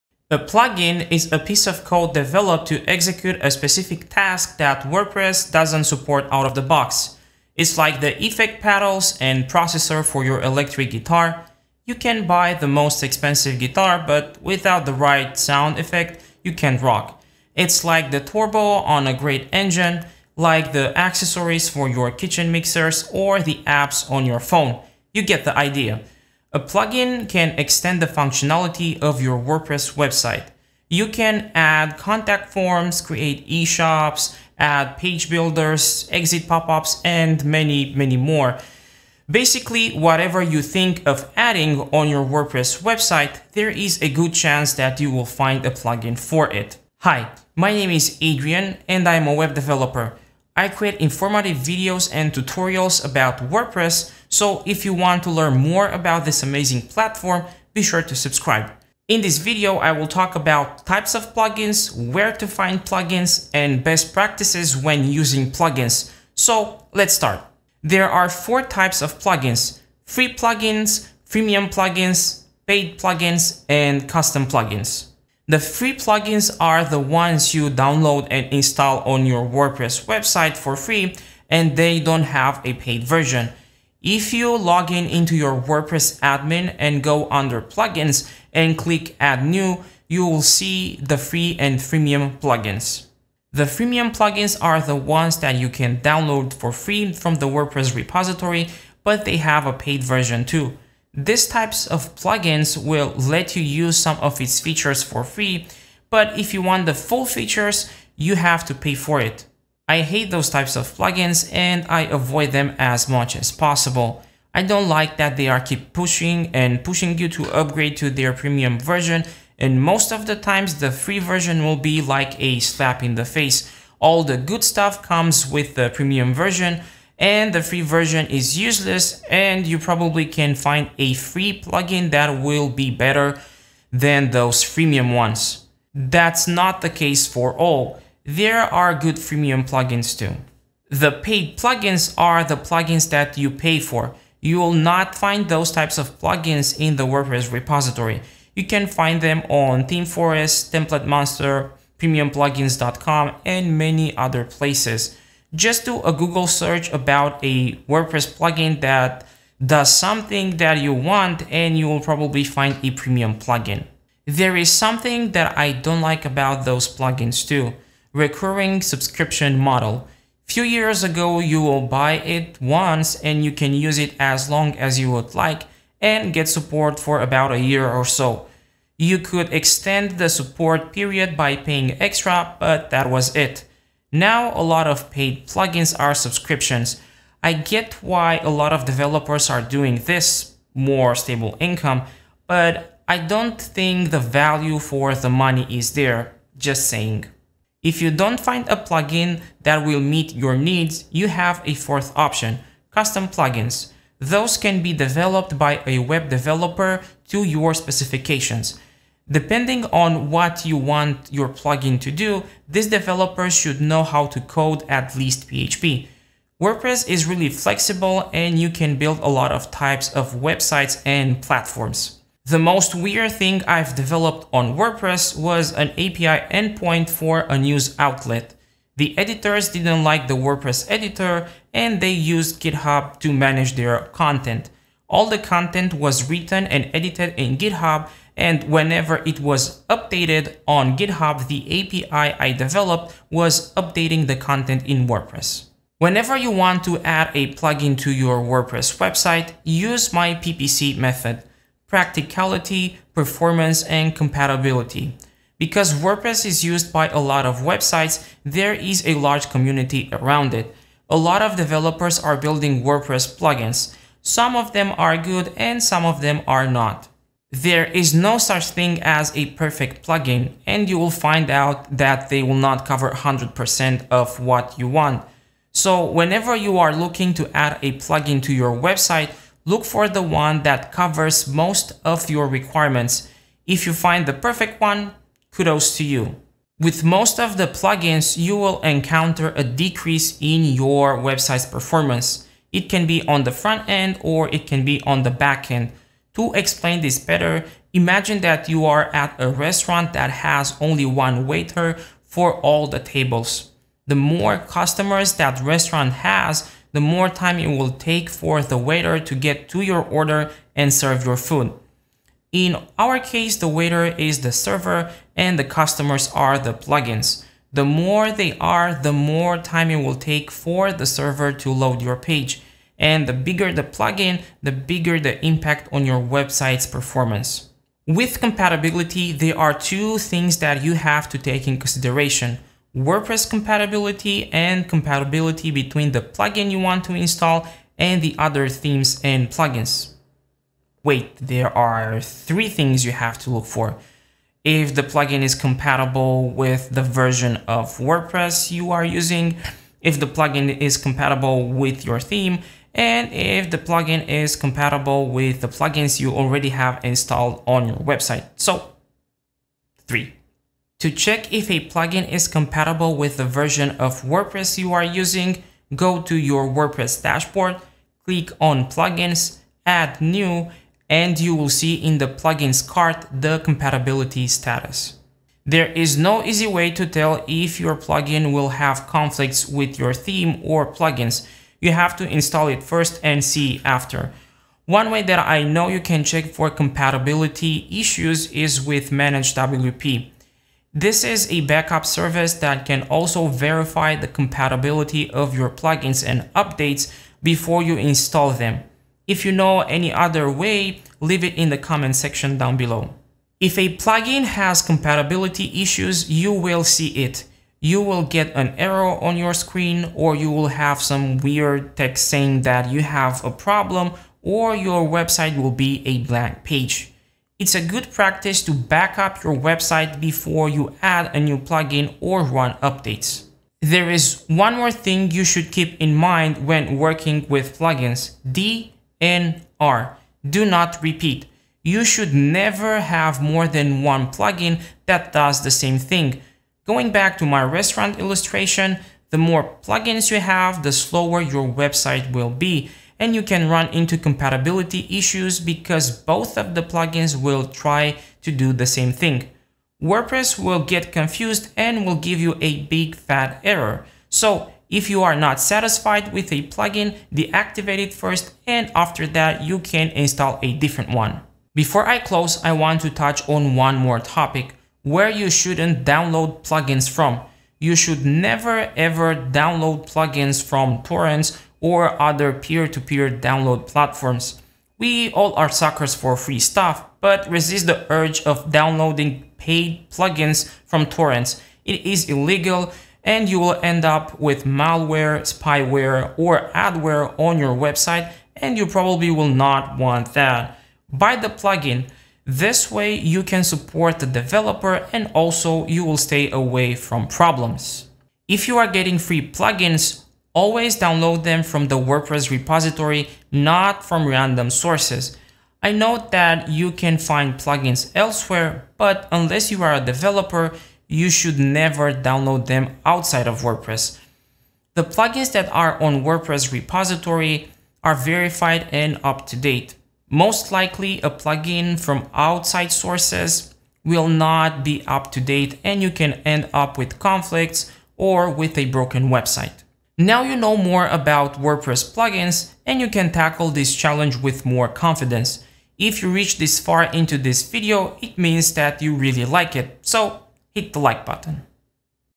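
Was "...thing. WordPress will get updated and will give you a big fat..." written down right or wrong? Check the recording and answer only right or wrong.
wrong.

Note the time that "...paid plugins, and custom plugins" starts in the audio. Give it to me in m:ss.
1:12.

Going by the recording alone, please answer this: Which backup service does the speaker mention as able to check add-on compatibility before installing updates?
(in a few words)
Manage WP.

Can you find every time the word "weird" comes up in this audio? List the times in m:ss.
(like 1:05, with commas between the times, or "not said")
3:42, 6:51.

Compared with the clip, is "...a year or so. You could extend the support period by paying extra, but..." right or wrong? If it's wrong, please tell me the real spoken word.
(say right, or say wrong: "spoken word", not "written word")
right.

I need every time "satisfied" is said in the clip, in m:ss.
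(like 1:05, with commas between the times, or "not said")
7:35.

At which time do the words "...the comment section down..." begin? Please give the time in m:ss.
6:41.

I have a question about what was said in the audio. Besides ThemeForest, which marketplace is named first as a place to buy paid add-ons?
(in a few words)
Template Monster.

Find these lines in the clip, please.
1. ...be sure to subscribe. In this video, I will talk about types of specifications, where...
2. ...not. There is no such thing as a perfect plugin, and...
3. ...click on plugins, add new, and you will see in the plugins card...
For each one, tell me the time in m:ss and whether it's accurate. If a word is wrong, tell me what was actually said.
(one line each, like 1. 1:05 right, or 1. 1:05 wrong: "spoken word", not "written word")
1. 0:57 wrong: "plugins", not "specifications"
2. 4:26 right
3. 6:08 right.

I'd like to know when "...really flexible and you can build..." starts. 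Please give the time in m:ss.
3:37.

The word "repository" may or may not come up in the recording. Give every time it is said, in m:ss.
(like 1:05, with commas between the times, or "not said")
1:37, 2:27, 8:22, 8:36.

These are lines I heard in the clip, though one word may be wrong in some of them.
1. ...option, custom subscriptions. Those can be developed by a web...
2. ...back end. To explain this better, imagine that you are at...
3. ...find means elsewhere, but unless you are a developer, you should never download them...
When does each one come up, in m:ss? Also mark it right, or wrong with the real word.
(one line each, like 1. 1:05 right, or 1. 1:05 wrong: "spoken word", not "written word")
1. 3:22 wrong: "plugins", not "subscriptions"
2. 4:55 right
3. 8:27 wrong: "plugins", not "means".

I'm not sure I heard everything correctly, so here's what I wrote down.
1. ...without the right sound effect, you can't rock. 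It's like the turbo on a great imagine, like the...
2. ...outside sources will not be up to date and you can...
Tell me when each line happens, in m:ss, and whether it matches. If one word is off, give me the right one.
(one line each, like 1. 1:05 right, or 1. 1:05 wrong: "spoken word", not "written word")
1. 0:14 wrong: "engine", not "imagine"
2. 8:42 right.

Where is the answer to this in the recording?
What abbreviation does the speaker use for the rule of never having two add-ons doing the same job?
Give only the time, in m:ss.
7:08.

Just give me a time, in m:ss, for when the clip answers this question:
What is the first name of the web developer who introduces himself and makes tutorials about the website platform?
0:48.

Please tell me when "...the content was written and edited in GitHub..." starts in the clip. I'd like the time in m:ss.
3:55.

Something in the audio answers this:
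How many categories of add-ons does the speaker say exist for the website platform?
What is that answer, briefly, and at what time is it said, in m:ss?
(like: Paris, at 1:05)
4, at 1:08.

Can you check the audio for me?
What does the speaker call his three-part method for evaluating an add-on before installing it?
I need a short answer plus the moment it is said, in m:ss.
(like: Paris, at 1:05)
PPC method, at 4:10.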